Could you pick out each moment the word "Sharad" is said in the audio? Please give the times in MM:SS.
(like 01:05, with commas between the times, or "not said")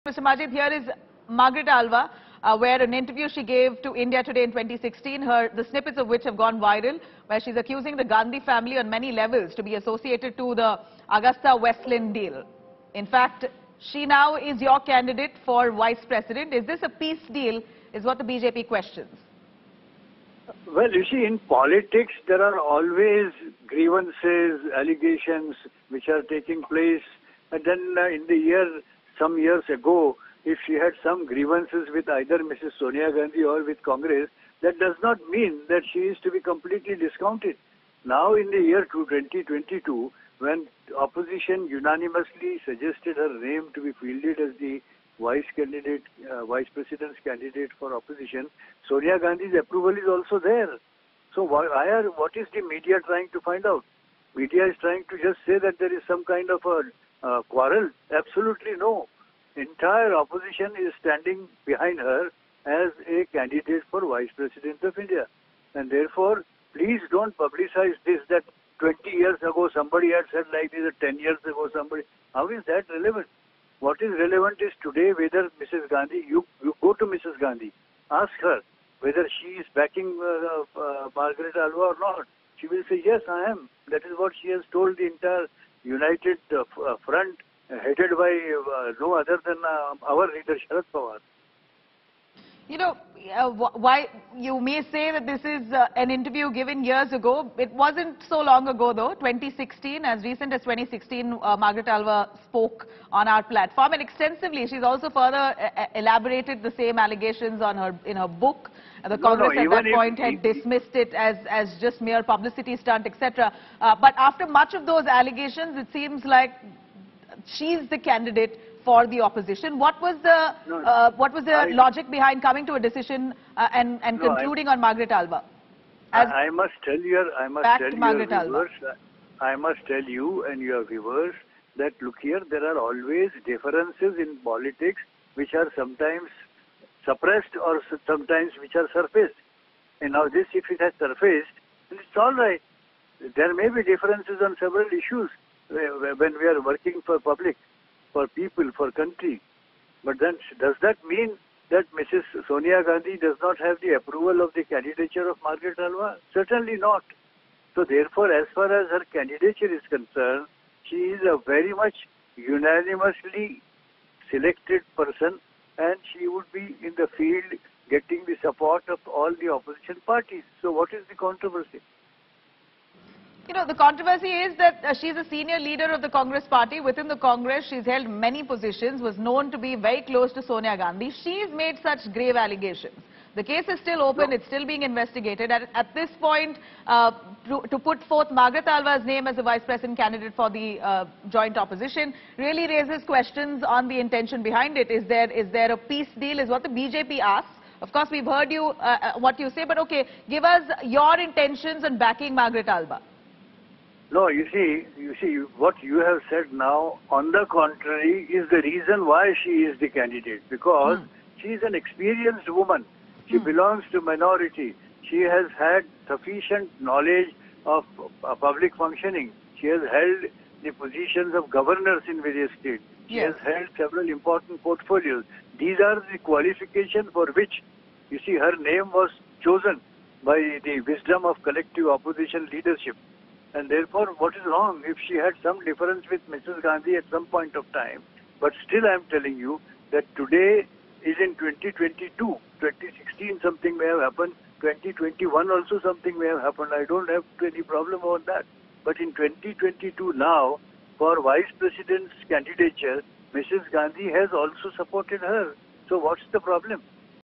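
01:30.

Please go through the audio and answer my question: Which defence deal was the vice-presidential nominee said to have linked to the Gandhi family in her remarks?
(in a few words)
Agusta Westland.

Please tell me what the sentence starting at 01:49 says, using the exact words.
The Congress no, no, at that point if, had if, dismissed it as, as just mere publicity stunt, etc.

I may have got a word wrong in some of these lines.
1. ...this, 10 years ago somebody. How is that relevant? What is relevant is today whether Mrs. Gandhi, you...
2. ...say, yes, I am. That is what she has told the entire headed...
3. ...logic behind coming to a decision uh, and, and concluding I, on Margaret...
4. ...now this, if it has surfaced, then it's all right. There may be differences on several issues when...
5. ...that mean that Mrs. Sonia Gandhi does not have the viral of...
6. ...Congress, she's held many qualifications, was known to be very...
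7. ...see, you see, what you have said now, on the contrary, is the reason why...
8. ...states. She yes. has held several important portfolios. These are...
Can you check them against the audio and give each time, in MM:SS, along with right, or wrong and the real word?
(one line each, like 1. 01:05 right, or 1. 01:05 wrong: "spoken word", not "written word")
1. 01:10 right
2. 01:22 wrong: "united", not "headed"
3. 02:01 right
4. 02:20 right
5. 02:30 wrong: "approval", not "viral"
6. 02:57 wrong: "positions", not "qualifications"
7. 03:24 right
8. 03:42 right.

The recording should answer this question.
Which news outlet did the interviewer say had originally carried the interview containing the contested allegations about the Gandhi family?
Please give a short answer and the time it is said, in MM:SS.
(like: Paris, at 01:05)
India Today, at 00:03.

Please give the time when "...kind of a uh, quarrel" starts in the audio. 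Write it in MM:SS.
00:56.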